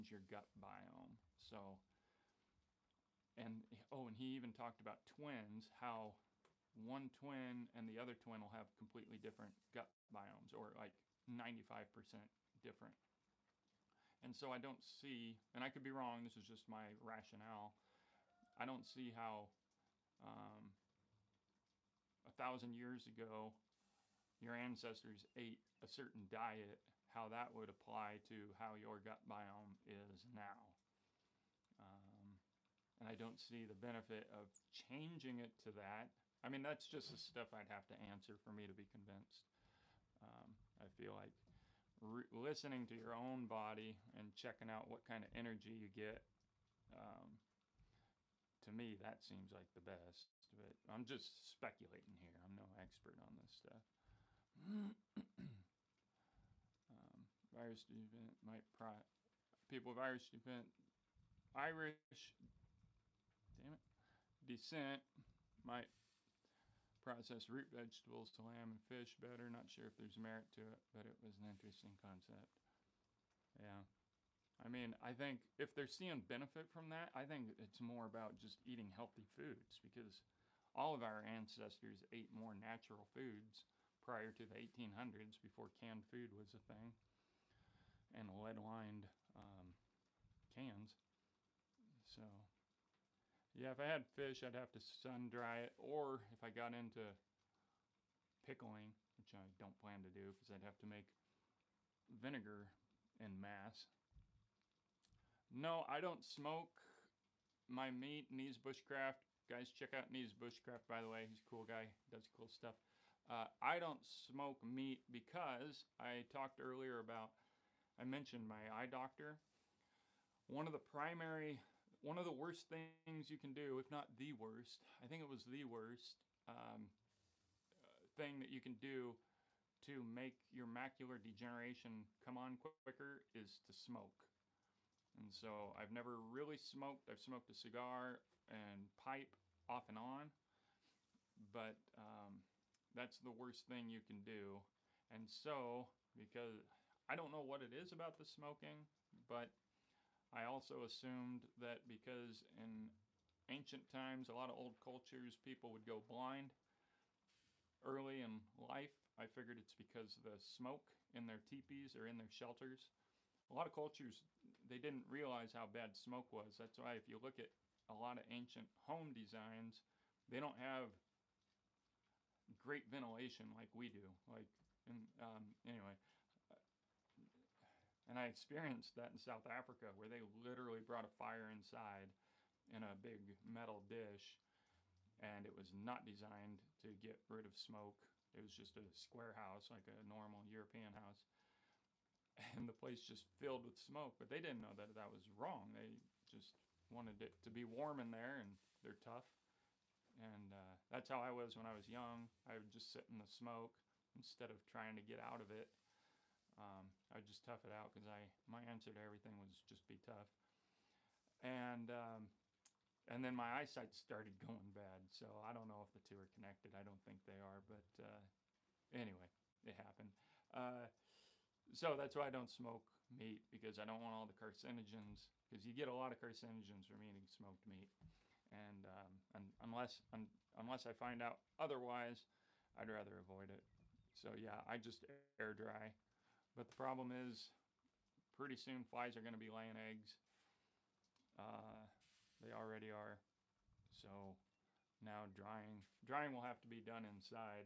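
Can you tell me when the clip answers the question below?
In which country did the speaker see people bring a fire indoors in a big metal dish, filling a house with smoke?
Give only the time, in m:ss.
2:59.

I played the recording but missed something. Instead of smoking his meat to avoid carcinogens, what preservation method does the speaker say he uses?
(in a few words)
air dry.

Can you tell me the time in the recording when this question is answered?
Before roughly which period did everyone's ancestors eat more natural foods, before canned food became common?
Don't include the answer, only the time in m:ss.
1:24.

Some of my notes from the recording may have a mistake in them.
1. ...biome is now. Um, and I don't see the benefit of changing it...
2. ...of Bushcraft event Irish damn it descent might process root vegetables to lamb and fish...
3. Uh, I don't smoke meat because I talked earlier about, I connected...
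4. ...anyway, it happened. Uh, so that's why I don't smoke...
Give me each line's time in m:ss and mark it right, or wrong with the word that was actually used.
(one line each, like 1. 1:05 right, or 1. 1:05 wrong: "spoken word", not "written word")
1. 0:29 right
2. 0:59 wrong: "Irish", not "Bushcraft"
3. 1:53 wrong: "mentioned", not "connected"
4. 3:38 right.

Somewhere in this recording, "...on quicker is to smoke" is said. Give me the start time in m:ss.
2:12.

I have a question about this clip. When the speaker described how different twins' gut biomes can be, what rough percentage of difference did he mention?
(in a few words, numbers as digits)
95%.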